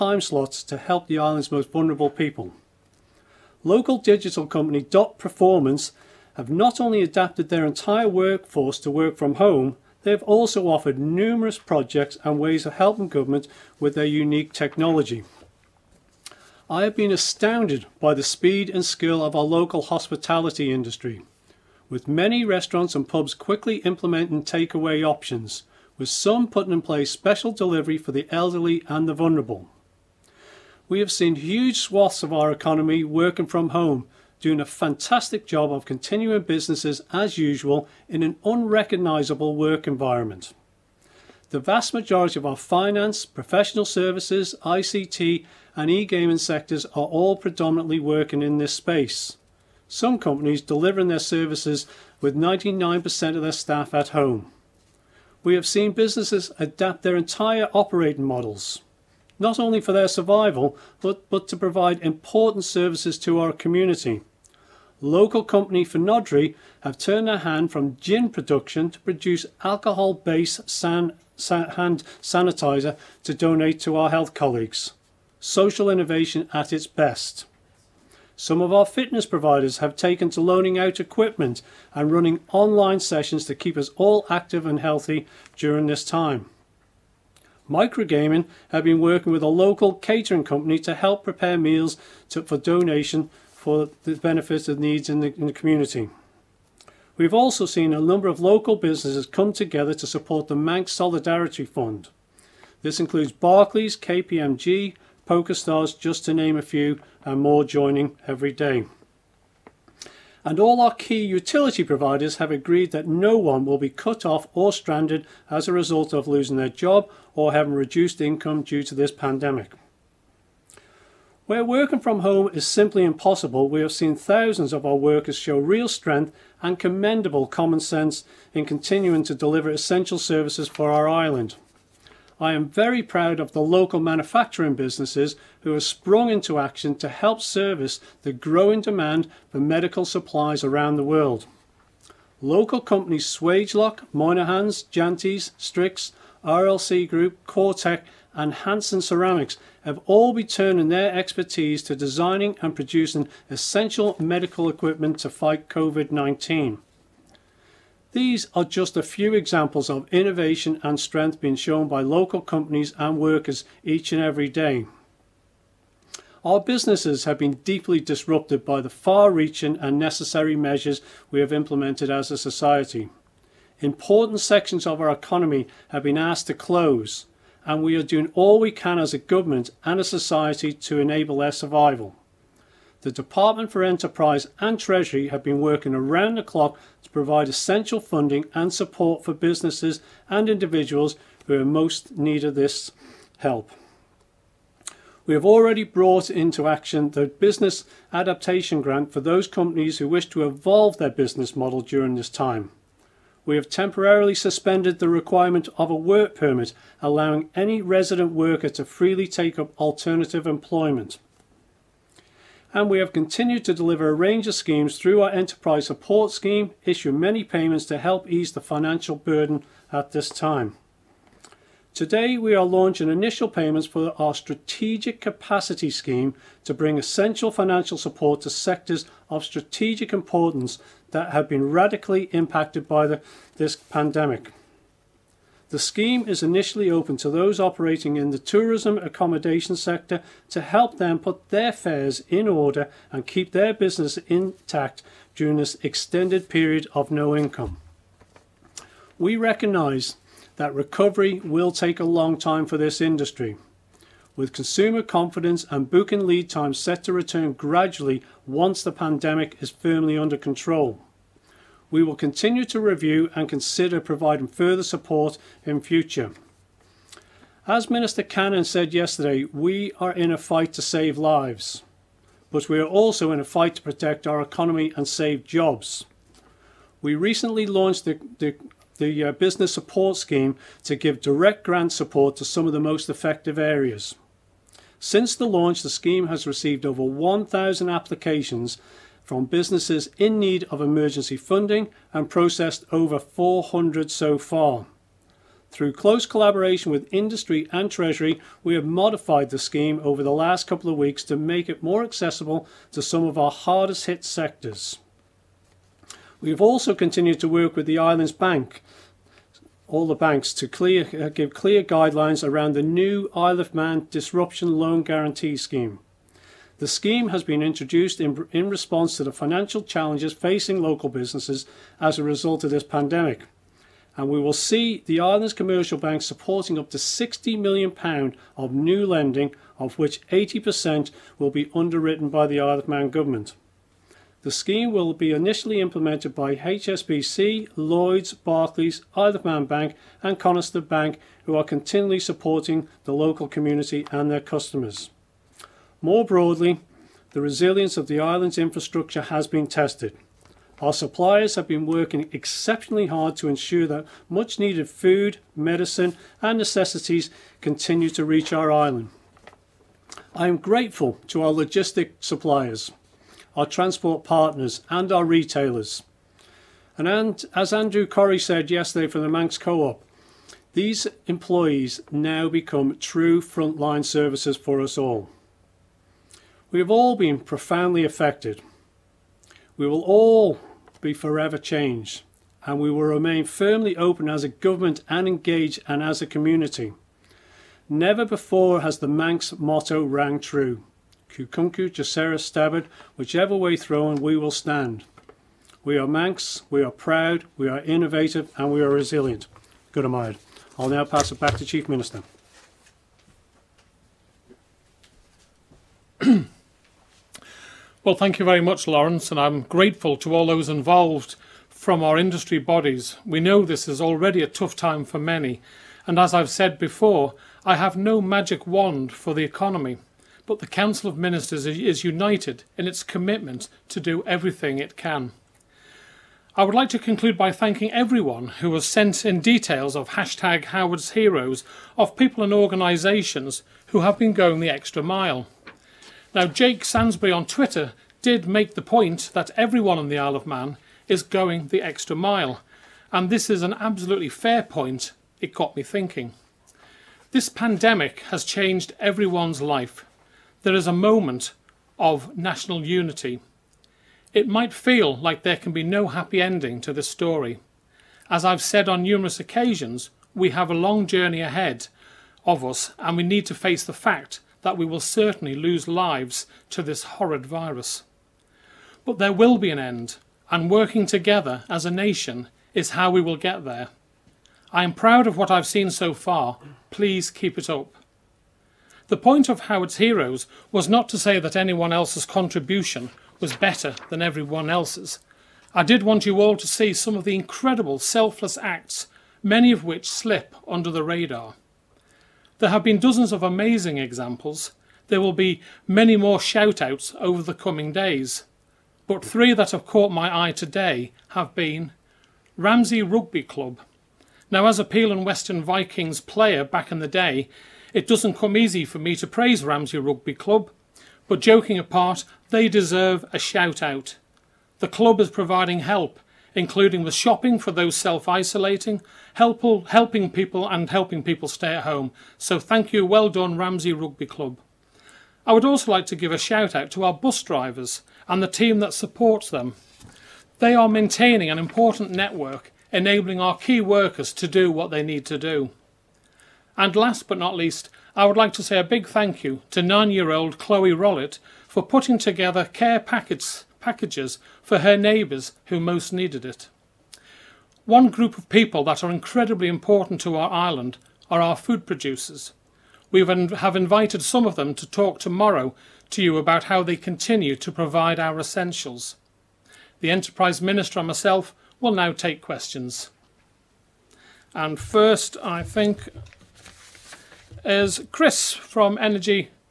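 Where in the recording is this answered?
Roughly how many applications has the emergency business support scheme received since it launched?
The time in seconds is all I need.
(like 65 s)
286 s.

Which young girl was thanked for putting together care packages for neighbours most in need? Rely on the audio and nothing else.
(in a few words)
Chloe Rollett.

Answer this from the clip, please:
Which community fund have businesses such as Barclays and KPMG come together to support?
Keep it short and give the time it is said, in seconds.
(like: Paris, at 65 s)
Manx Solidarity Fund, at 100 s.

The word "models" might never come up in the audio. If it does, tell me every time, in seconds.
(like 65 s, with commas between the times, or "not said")
58 s, 201 s.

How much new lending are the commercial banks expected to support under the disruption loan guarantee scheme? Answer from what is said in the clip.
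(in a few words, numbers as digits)
£60 million.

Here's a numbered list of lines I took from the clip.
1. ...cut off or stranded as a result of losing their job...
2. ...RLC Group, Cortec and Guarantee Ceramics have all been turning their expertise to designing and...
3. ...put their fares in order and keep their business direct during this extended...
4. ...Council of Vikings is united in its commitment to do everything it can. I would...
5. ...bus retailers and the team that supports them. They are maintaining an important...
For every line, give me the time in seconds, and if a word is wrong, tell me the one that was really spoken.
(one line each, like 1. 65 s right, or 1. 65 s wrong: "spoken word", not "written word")
1. 113 s right
2. 146 s wrong: "Hanson", not "Guarantee"
3. 241 s wrong: "intact", not "direct"
4. 420 s wrong: "Ministers", not "Vikings"
5. 527 s wrong: "drivers", not "retailers".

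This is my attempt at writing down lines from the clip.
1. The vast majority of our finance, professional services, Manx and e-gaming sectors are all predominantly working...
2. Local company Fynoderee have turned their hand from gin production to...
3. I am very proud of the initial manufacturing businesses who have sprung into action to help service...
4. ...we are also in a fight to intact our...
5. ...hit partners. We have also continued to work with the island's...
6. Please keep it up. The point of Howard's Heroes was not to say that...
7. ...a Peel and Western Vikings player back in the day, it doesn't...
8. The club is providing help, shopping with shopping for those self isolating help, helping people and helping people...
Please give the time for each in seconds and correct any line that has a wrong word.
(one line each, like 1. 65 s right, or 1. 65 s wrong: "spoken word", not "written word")
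1. 41 s wrong: "ICT", not "Manx"
2. 65 s right
3. 132 s wrong: "local", not "initial"
4. 272 s wrong: "protect", not "intact"
5. 304 s wrong: "sectors", not "partners"
6. 476 s right
7. 504 s right
8. 514 s wrong: "including", not "shopping".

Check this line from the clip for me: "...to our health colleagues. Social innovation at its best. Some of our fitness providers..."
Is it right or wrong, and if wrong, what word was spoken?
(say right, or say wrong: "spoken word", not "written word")
right.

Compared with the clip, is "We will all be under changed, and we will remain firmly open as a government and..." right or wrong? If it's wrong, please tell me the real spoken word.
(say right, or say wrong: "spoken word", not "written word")
wrong: "forever", not "under".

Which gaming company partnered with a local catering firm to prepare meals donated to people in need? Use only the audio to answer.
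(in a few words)
Microgaming.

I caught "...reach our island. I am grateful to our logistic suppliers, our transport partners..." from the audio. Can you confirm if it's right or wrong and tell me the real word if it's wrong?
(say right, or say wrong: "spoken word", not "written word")
right.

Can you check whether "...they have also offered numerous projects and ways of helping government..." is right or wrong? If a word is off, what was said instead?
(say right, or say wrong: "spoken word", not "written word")
right.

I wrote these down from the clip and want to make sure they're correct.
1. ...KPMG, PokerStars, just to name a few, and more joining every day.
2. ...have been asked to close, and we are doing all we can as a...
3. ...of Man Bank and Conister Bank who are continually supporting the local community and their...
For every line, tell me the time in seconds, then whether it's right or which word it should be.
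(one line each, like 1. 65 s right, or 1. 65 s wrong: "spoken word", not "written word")
1. 103 s right
2. 175 s right
3. 339 s right.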